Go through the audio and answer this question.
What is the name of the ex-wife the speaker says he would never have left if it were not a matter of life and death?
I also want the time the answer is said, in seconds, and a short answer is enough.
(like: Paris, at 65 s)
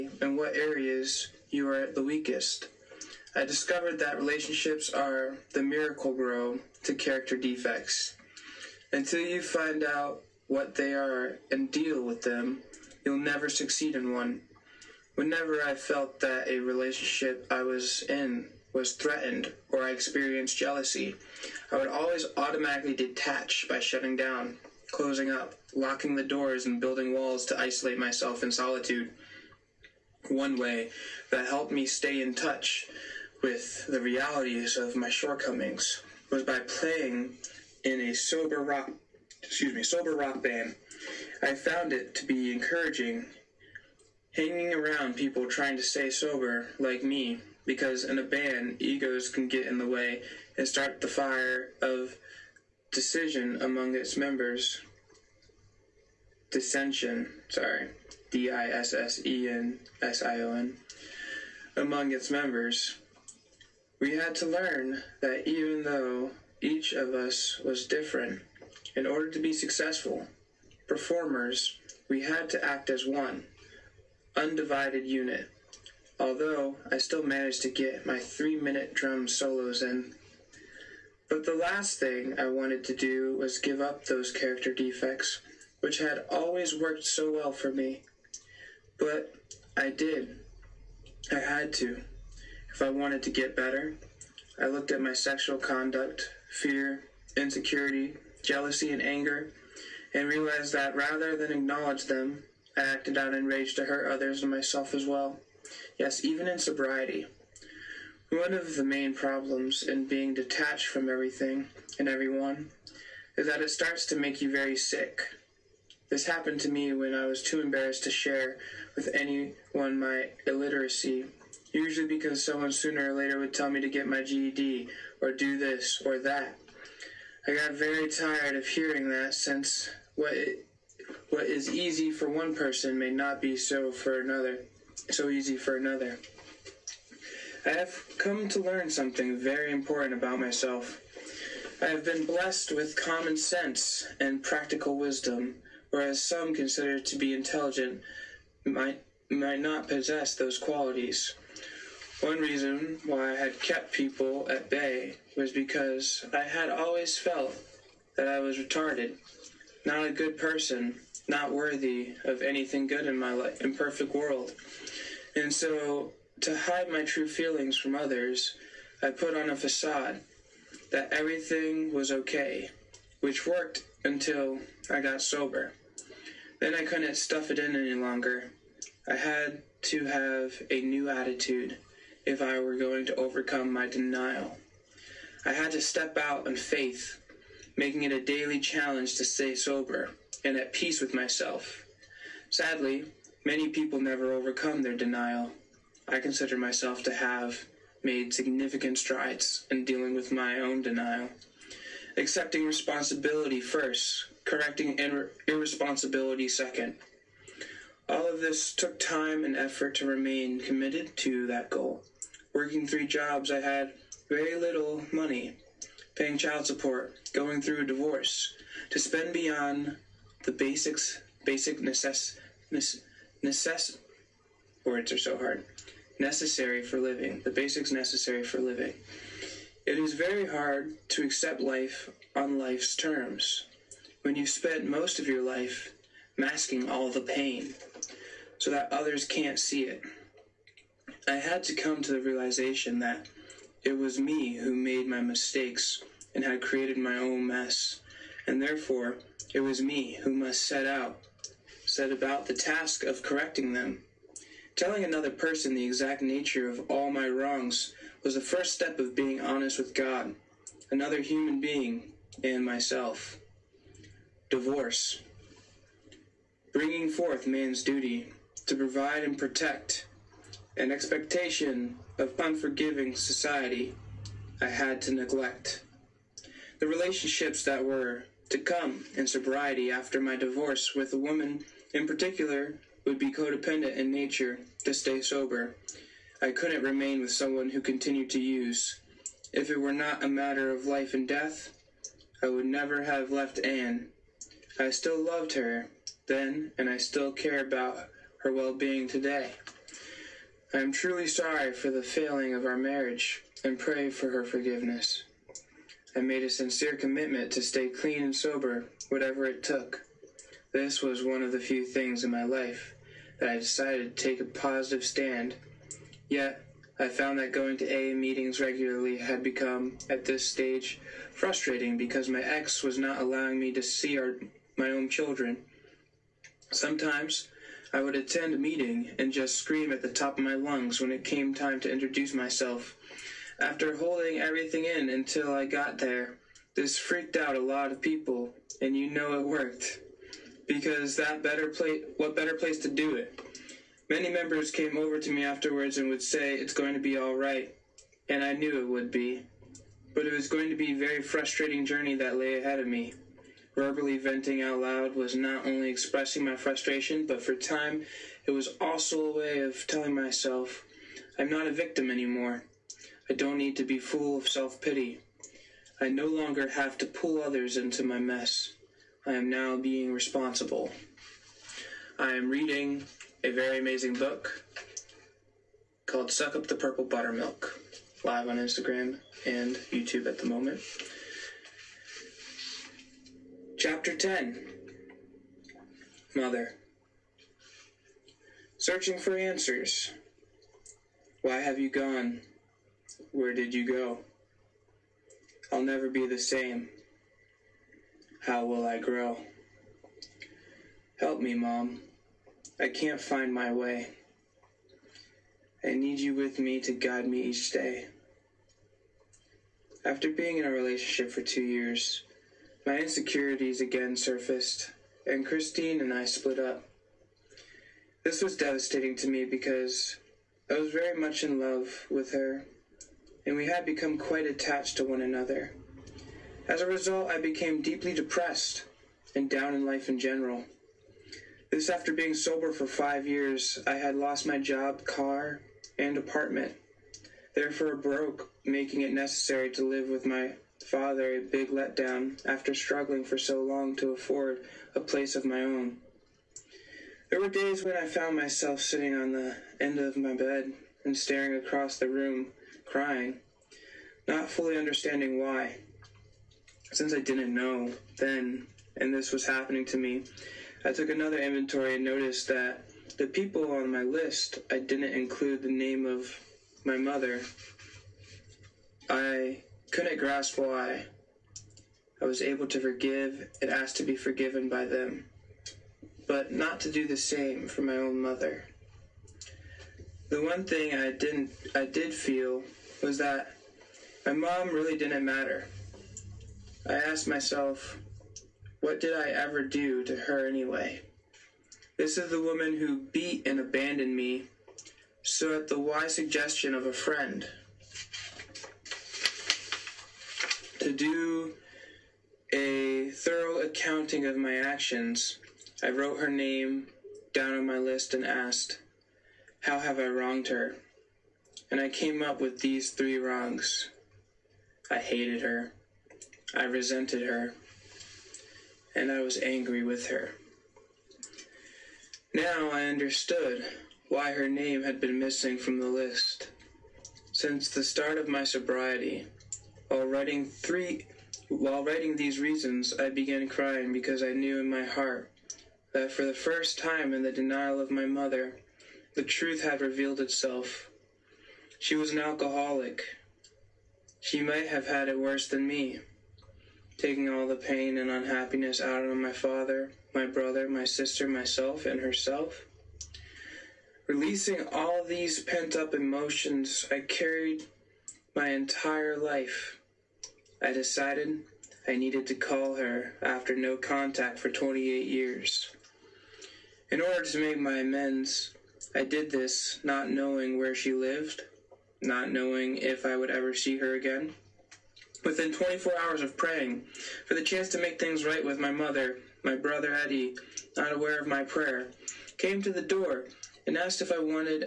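Anne, at 293 s.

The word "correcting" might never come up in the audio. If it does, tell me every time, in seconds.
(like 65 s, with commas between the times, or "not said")
204 s, 253 s.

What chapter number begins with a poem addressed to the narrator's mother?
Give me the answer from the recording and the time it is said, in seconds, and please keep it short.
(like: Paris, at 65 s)
10, at 383 s.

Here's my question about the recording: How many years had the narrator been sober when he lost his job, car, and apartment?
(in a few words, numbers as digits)
5.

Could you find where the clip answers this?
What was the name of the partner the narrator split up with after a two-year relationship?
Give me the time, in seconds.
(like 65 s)
415 s.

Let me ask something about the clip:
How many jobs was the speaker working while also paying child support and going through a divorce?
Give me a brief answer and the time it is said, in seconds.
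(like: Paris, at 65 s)
3, at 212 s.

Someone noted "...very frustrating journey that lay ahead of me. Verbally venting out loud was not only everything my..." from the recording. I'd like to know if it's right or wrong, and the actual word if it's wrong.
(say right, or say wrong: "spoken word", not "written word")
wrong: "expressing", not "everything".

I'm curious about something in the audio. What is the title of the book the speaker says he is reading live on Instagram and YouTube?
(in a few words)
Suck Up the Purple Buttermilk.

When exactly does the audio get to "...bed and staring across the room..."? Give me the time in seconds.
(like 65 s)
450 s.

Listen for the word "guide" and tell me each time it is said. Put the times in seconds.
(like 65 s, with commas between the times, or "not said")
406 s.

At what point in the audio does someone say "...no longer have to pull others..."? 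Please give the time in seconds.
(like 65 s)
366 s.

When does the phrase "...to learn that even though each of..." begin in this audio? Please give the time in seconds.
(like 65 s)
64 s.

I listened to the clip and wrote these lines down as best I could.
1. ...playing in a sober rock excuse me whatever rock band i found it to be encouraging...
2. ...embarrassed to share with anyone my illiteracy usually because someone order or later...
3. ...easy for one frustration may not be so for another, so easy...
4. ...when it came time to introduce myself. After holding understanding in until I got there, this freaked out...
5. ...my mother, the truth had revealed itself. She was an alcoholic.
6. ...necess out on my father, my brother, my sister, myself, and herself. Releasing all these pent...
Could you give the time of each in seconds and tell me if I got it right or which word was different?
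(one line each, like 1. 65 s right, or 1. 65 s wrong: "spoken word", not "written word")
1. 36 s wrong: "sober", not "whatever"
2. 117 s wrong: "sooner", not "order"
3. 131 s wrong: "person", not "frustration"
4. 331 s wrong: "everything", not "understanding"
5. 537 s right
6. 548 s wrong: "unhappiness", not "necess".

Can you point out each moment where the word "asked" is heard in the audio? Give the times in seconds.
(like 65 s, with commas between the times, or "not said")
486 s, 508 s, 583 s.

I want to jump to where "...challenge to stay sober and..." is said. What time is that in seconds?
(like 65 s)
188 s.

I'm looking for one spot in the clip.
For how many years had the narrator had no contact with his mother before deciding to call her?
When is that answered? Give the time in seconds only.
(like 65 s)
564 s.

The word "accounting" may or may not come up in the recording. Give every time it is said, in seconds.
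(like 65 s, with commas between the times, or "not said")
503 s.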